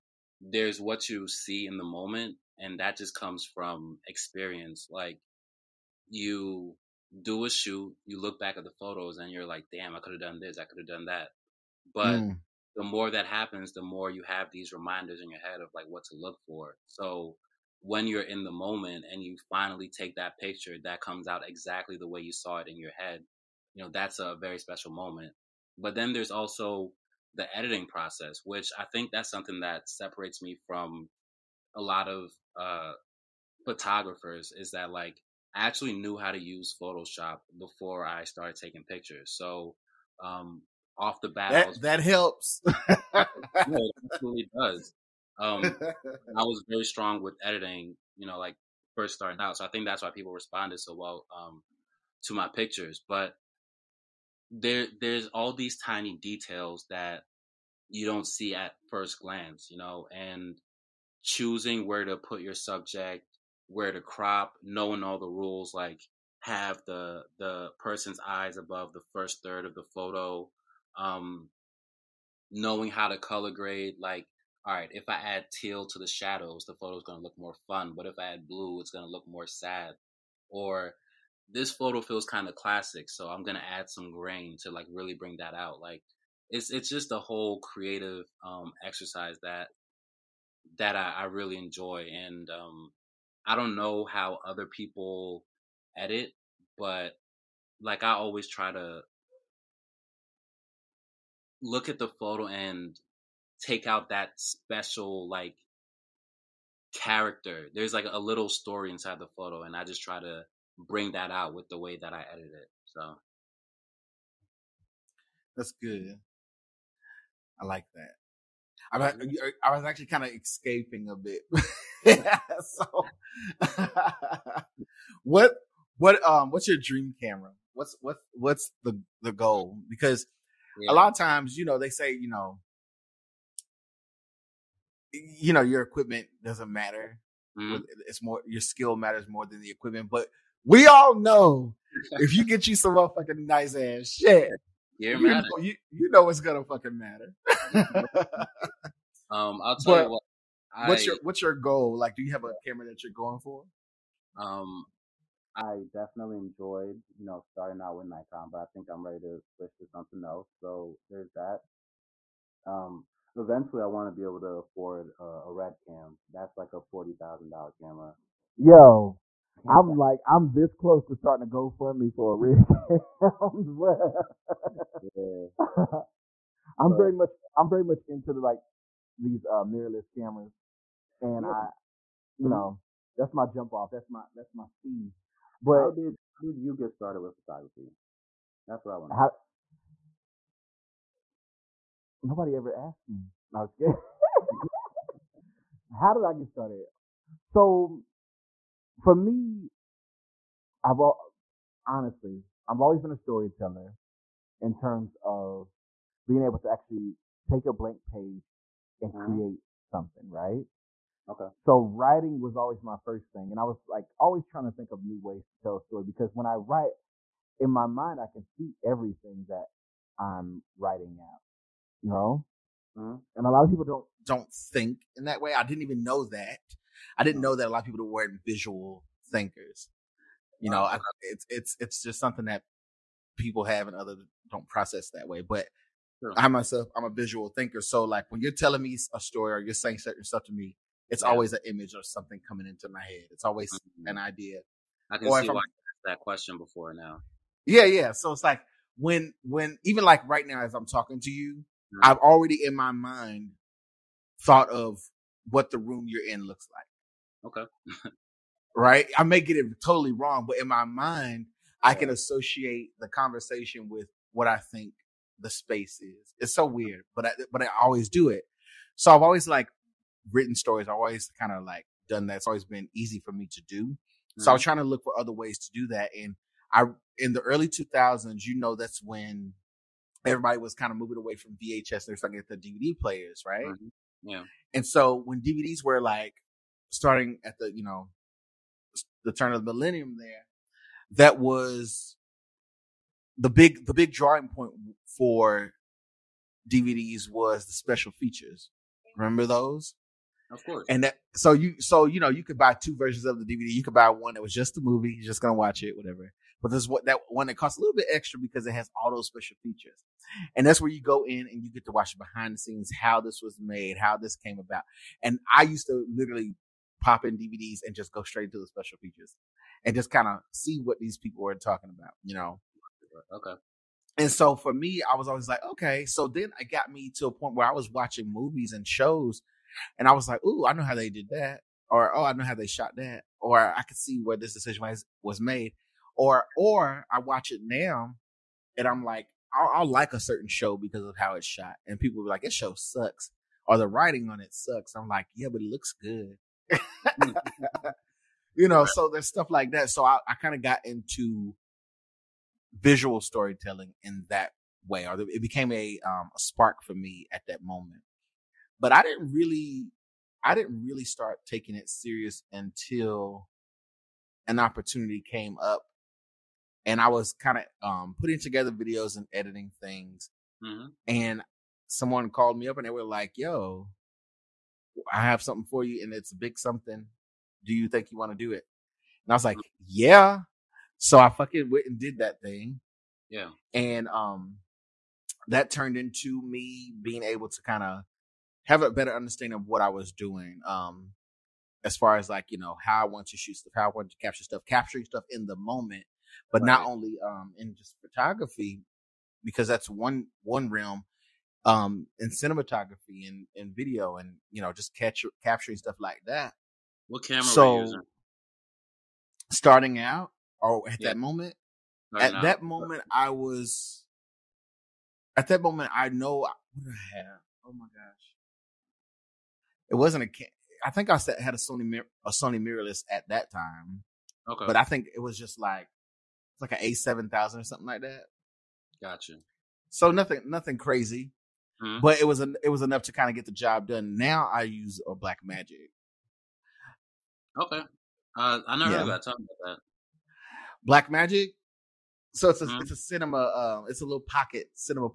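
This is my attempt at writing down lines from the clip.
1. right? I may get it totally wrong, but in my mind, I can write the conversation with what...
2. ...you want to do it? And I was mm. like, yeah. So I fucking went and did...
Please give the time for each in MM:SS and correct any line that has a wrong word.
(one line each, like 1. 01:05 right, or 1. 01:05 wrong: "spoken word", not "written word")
1. 04:18 wrong: "associate", not "write"
2. 06:18 right.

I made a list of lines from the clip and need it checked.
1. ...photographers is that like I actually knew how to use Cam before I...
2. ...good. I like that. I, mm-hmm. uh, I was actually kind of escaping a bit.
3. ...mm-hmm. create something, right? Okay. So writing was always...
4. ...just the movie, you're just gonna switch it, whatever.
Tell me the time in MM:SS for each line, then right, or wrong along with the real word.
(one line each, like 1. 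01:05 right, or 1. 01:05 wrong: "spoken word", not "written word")
1. 00:33 wrong: "Photoshop", not "Cam"
2. 01:55 right
3. 03:29 right
4. 05:04 wrong: "watch", not "switch".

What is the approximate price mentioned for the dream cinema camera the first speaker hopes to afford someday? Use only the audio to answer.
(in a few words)
$40,000.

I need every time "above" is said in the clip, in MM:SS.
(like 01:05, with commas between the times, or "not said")
01:08.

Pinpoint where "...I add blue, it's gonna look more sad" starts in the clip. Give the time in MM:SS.
01:18.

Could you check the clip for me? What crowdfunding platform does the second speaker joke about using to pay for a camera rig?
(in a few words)
GoFundMe.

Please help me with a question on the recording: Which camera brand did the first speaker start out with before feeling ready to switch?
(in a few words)
Nikon.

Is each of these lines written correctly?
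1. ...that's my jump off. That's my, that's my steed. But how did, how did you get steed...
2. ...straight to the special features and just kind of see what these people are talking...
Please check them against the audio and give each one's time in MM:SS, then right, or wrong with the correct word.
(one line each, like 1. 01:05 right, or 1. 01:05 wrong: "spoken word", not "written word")
1. 03:03 wrong: "started", not "steed"
2. 05:18 right.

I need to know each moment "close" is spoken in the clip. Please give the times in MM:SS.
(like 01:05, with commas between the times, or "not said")
02:50.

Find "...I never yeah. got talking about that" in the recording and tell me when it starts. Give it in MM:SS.
07:18.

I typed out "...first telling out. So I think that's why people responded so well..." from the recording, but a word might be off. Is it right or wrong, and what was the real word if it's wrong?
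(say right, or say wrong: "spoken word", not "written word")
wrong: "starting", not "telling".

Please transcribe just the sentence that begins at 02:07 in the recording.
What's what what's the the goal?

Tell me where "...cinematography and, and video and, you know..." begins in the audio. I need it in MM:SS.
06:42.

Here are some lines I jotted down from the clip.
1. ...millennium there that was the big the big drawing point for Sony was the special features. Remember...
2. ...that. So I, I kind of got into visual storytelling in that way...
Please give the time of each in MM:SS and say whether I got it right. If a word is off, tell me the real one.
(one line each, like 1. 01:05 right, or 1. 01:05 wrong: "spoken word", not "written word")
1. 04:49 wrong: "DVDs", not "Sony"
2. 05:49 right.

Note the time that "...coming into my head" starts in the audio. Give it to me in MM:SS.
04:02.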